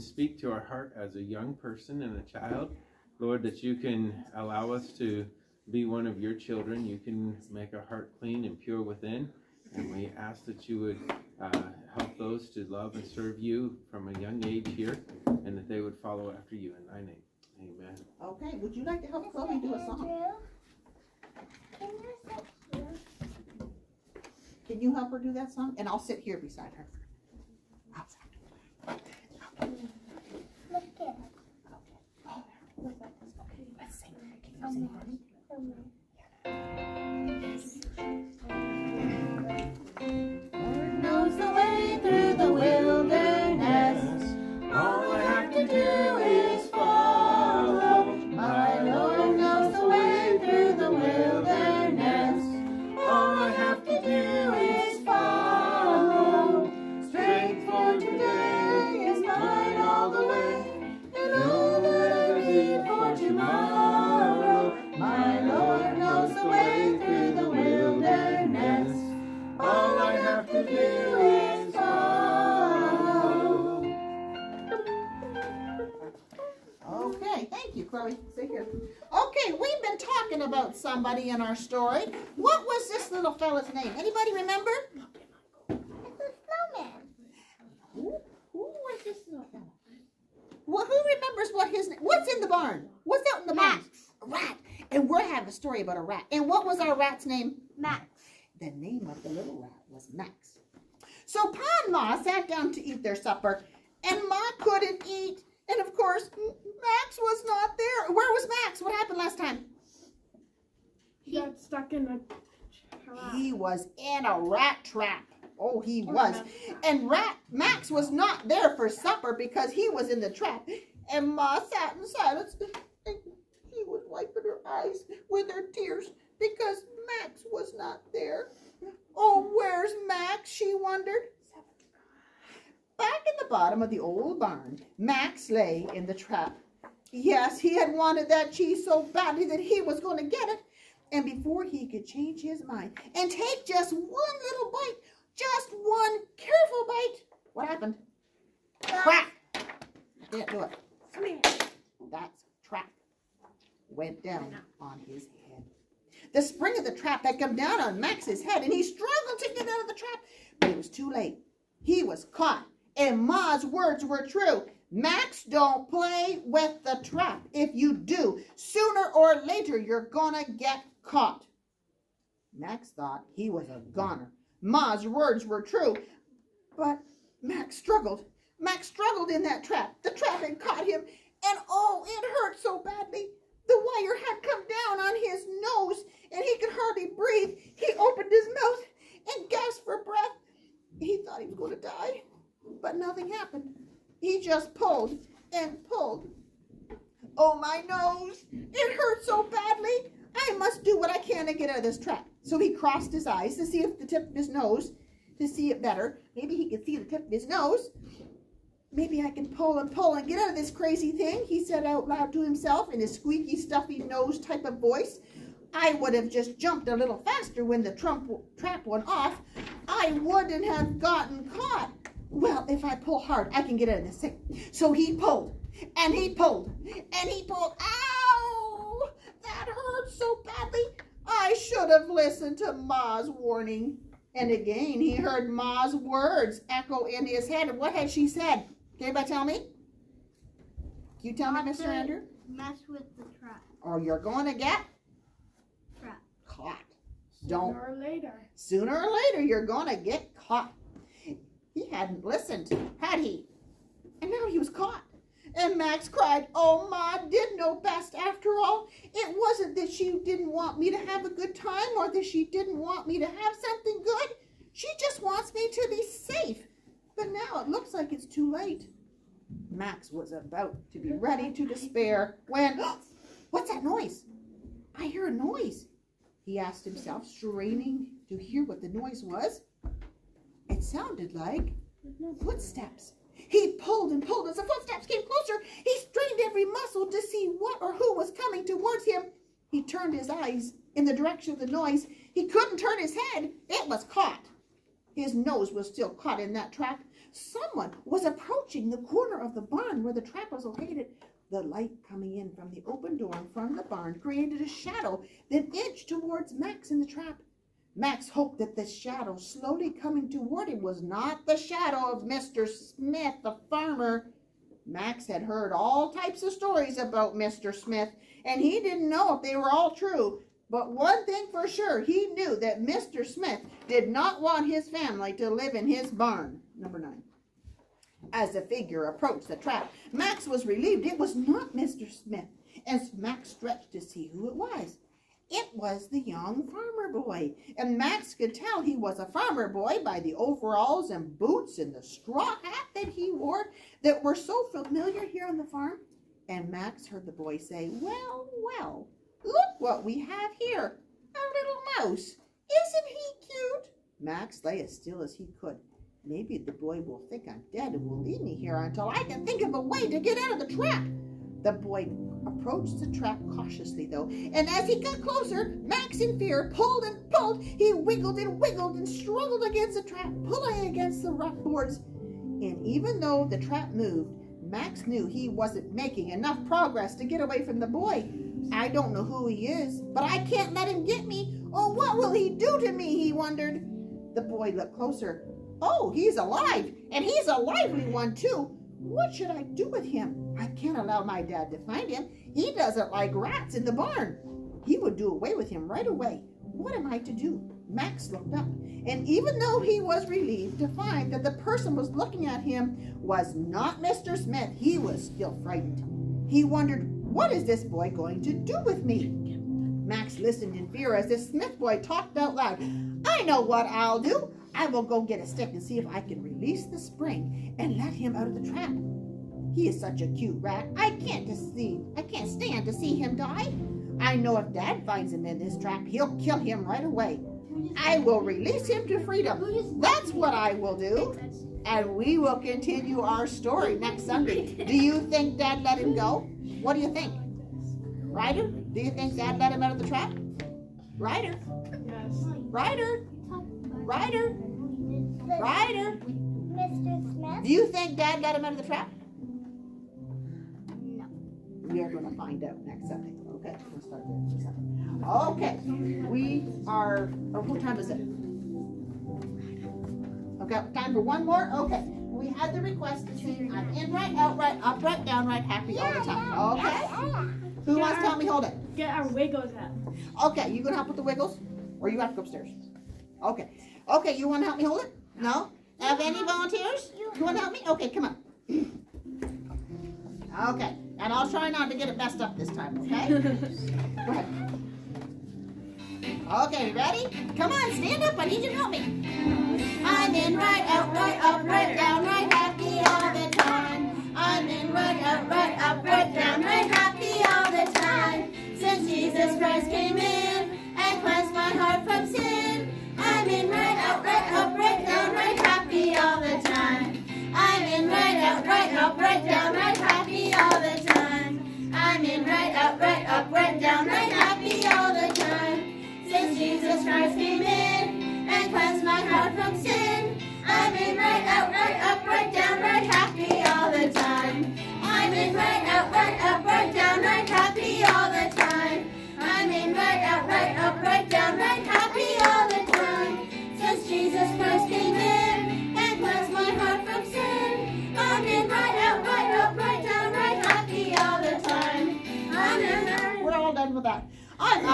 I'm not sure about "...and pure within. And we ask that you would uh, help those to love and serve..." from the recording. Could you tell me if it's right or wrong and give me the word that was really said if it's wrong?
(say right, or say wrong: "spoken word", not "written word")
right.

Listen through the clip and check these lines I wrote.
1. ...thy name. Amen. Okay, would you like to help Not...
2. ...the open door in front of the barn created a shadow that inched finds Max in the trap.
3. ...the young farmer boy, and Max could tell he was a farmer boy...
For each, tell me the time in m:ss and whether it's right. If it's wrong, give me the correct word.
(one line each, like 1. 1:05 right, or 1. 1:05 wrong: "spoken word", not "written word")
1. 0:16 wrong: "Chloe", not "Not"
2. 5:02 wrong: "towards", not "finds"
3. 5:36 right.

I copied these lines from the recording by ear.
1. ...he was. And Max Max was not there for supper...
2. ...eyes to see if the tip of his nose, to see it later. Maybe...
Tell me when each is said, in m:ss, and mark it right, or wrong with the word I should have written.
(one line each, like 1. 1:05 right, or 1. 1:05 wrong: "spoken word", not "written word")
1. 1:55 wrong: "Rat", not "Max"
2. 3:23 wrong: "better", not "later".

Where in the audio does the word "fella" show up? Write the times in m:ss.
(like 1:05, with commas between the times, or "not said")
1:23, 1:29.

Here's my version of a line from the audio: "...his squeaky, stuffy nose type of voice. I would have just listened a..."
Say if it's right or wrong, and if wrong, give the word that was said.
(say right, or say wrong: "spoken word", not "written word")
wrong: "jumped", not "listened".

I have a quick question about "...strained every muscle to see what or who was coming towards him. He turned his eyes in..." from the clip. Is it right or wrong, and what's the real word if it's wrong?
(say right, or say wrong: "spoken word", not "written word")
right.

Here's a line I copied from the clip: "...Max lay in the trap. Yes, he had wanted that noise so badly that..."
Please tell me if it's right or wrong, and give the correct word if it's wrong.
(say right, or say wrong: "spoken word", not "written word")
wrong: "cheese", not "noise".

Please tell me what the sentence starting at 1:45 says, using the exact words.
And of course, Max was not there.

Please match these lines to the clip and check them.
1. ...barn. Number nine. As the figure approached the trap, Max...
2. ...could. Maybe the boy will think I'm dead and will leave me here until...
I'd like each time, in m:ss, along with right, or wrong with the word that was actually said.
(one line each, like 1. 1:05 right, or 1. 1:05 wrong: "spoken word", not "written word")
1. 5:26 right
2. 5:55 right.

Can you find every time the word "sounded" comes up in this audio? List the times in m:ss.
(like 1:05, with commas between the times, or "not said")
4:40.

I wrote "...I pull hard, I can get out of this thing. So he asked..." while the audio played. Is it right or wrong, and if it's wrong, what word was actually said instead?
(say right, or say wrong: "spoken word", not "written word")
wrong: "pulled", not "asked".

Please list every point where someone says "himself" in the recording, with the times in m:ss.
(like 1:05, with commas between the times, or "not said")
3:32, 4:36.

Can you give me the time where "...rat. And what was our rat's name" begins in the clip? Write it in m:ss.
1:36.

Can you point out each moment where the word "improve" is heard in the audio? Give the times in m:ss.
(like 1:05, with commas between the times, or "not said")
not said.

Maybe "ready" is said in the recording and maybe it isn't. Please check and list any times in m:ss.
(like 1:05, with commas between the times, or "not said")
4:31, 8:06.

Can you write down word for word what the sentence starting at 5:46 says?
And Max heard the boy say, well, well, look what we have here, a little mouse.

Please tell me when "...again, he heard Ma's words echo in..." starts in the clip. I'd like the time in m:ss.
3:54.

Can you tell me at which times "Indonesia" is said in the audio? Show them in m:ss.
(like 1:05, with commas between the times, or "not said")
not said.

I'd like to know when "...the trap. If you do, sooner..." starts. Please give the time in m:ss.
2:46.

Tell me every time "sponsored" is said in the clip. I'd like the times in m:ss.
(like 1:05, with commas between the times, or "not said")
not said.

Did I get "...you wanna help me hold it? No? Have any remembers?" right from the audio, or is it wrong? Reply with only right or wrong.
wrong.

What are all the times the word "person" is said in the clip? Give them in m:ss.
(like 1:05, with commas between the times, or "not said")
0:01, 6:41.